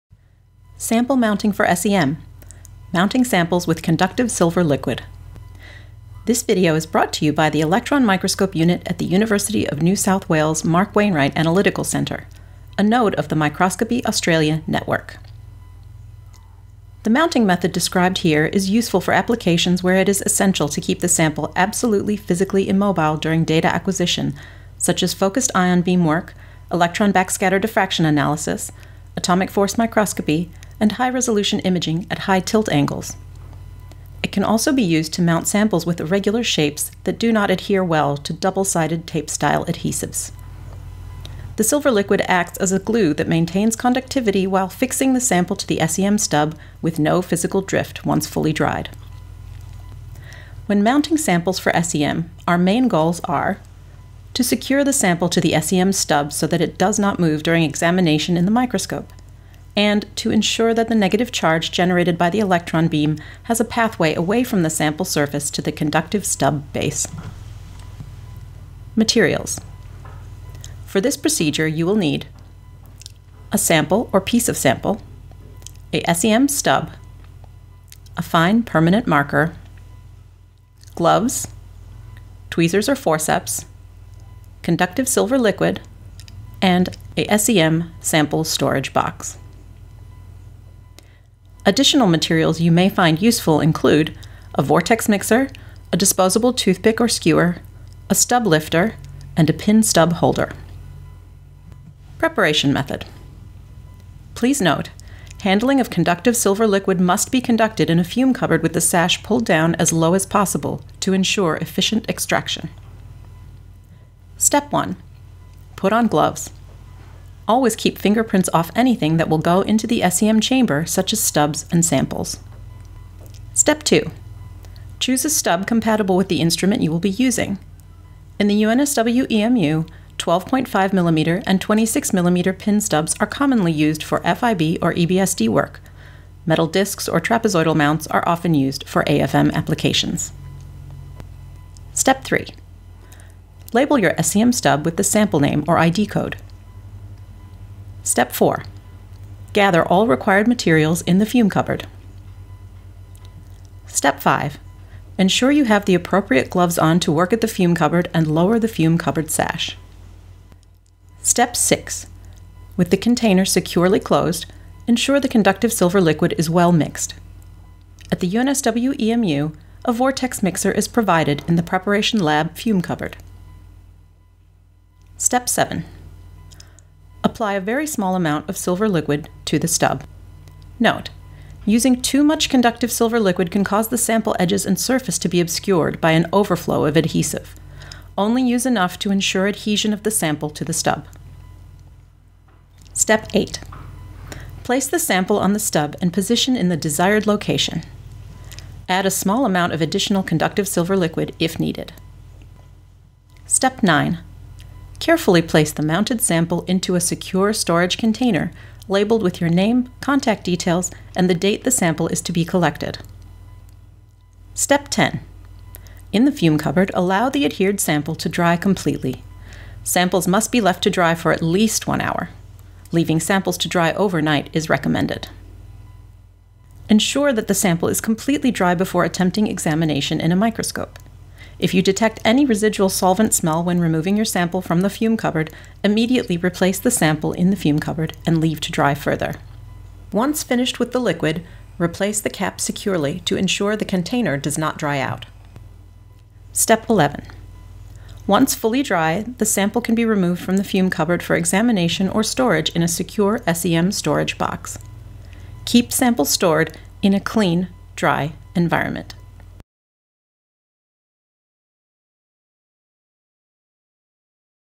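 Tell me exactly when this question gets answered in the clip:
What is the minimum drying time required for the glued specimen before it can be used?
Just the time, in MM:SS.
03:41.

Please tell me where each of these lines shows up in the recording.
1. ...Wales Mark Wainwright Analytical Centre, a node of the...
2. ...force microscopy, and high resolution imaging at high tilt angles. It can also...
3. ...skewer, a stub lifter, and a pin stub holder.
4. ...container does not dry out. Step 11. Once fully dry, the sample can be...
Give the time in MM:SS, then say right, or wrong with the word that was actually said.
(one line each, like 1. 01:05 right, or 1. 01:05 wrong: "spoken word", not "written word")
1. 00:10 right
2. 00:29 right
3. 01:37 right
4. 04:03 right.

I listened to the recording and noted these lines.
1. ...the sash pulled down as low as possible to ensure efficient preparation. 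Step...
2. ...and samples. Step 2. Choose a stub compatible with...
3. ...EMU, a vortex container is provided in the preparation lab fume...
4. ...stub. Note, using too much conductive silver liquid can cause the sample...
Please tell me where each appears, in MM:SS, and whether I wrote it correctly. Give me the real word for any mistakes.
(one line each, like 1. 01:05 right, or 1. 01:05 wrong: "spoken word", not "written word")
1. 01:48 wrong: "extraction", not "preparation"
2. 02:01 right
3. 02:48 wrong: "mixer", not "container"
4. 02:59 right.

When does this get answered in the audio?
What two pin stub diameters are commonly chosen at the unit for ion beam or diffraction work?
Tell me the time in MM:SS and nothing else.
02:10.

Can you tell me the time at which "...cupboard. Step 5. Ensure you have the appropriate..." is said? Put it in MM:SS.
02:31.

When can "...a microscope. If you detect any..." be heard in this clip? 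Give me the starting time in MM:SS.
03:50.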